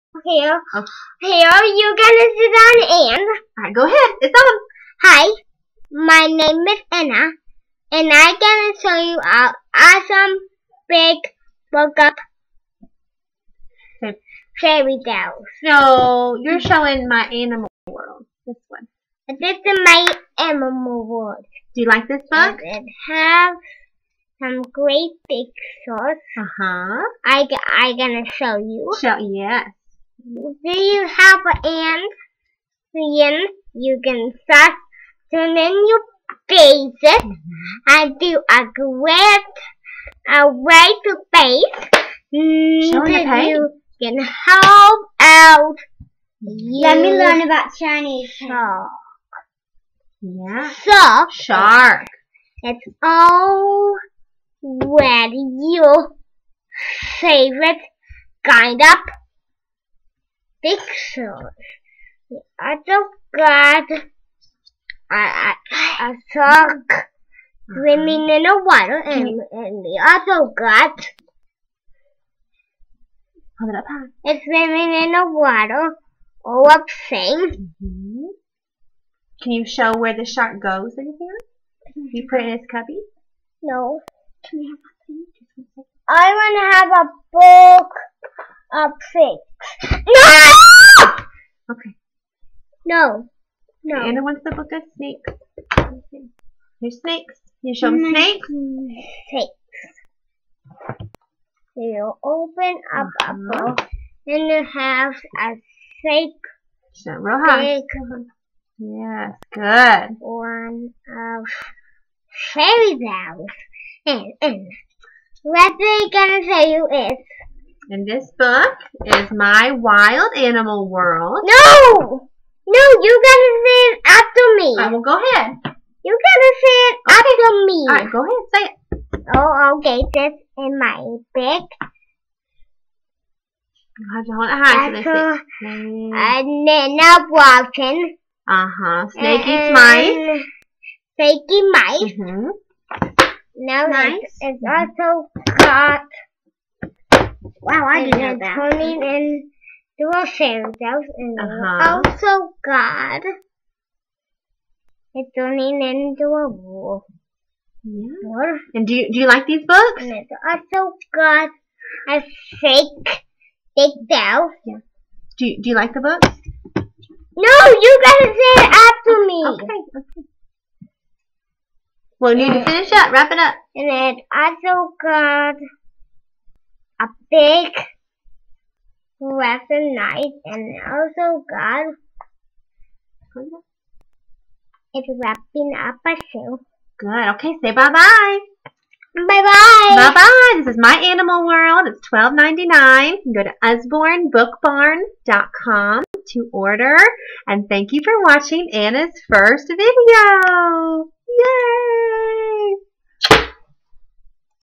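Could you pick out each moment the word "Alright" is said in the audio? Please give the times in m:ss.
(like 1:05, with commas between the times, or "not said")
0:03, 2:07.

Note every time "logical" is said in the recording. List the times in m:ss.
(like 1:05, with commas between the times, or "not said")
not said.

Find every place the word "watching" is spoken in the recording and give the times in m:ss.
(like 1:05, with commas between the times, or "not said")
3:18.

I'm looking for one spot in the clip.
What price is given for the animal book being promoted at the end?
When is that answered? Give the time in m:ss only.
3:12.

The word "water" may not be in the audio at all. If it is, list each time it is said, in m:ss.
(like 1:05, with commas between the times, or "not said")
1:08, 1:15.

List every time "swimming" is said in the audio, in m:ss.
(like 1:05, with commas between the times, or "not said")
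1:07, 1:14.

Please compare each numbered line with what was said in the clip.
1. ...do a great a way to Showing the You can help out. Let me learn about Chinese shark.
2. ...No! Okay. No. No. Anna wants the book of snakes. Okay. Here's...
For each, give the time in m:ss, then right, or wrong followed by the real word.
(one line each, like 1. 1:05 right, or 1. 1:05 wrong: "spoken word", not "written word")
1. 0:38 right
2. 1:30 right.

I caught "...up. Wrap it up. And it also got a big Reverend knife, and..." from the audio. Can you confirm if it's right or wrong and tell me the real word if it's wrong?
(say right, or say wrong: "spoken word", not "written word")
right.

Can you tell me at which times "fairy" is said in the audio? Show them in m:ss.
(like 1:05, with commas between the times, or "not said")
0:14, 1:52, 2:30.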